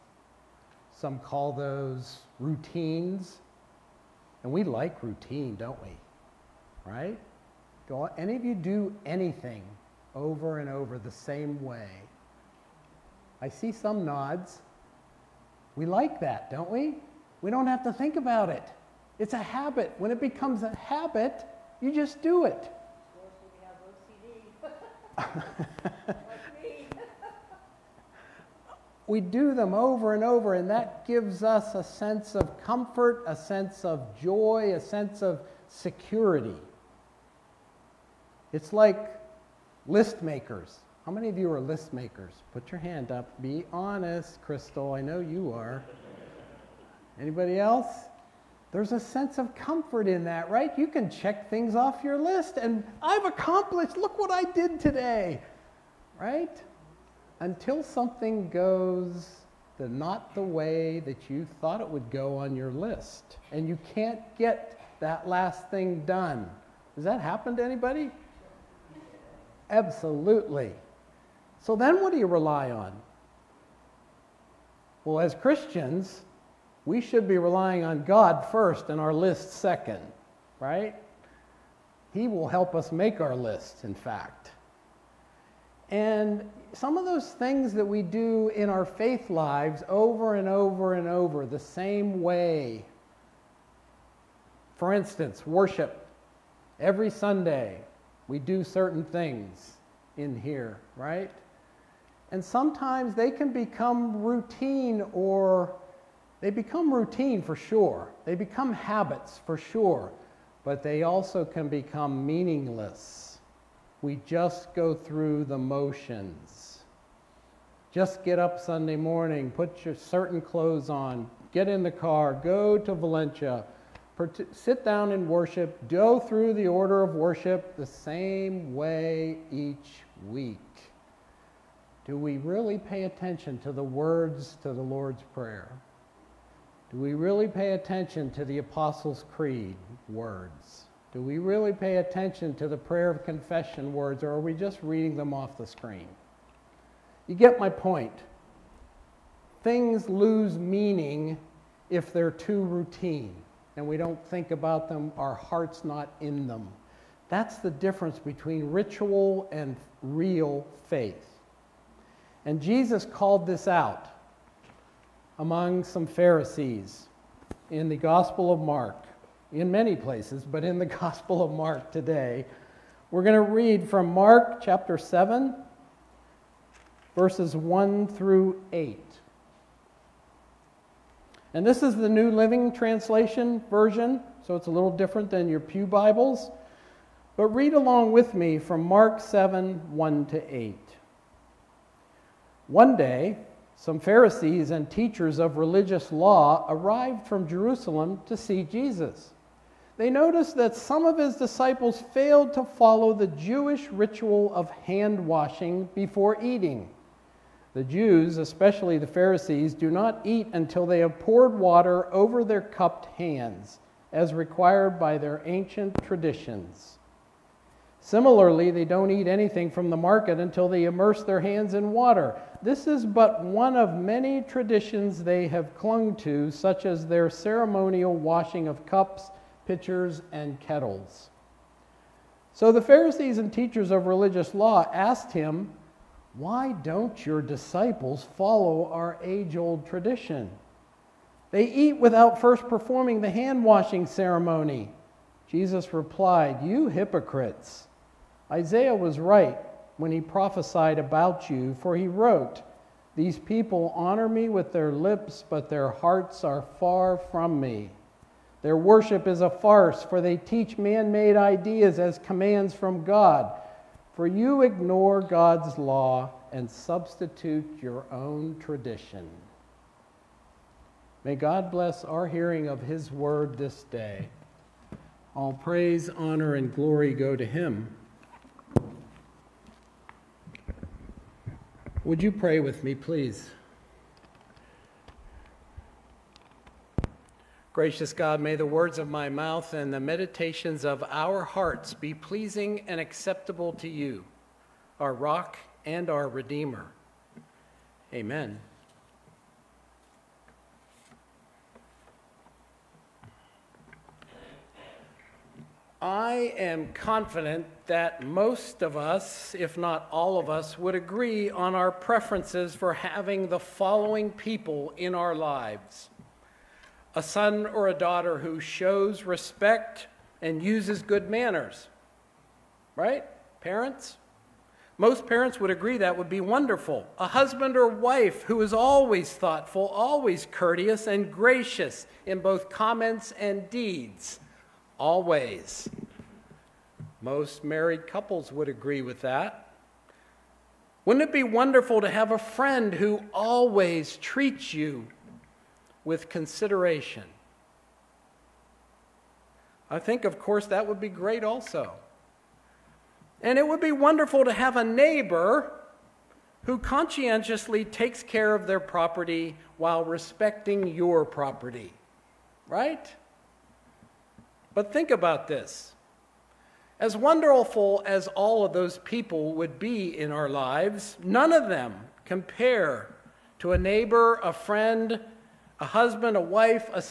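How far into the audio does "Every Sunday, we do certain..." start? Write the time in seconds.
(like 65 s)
96 s.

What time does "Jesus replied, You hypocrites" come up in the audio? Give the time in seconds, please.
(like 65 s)
245 s.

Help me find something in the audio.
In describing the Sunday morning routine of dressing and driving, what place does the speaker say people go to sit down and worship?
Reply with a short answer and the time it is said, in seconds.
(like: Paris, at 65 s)
Valencia, at 122 s.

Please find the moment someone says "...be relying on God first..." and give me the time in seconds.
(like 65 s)
77 s.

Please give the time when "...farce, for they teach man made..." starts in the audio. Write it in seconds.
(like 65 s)
259 s.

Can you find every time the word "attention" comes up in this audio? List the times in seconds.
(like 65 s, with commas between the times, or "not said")
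133 s, 137 s, 141 s.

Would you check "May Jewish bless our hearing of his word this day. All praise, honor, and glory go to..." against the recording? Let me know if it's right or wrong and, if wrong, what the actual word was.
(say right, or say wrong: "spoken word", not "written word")
wrong: "God", not "Jewish".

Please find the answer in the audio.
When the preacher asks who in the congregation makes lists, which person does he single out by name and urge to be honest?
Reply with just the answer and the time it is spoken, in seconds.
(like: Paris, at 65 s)
Crystal, at 44 s.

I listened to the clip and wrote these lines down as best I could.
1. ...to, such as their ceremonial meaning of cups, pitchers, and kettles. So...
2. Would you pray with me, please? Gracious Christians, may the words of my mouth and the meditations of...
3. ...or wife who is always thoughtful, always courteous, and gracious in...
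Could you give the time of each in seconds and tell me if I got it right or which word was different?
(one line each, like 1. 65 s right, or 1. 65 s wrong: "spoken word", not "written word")
1. 226 s wrong: "washing", not "meaning"
2. 282 s wrong: "God", not "Christians"
3. 327 s right.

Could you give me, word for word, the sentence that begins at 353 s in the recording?
And it would be wonderful to have a neighbor who conscientiously takes care of their property while respecting your property, right?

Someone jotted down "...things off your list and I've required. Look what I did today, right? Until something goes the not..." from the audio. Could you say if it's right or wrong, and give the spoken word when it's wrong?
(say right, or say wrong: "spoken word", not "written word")
wrong: "accomplished", not "required".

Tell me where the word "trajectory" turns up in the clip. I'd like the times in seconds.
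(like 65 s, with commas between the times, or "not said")
not said.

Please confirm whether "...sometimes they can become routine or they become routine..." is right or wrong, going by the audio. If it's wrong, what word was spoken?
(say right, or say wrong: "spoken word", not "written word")
right.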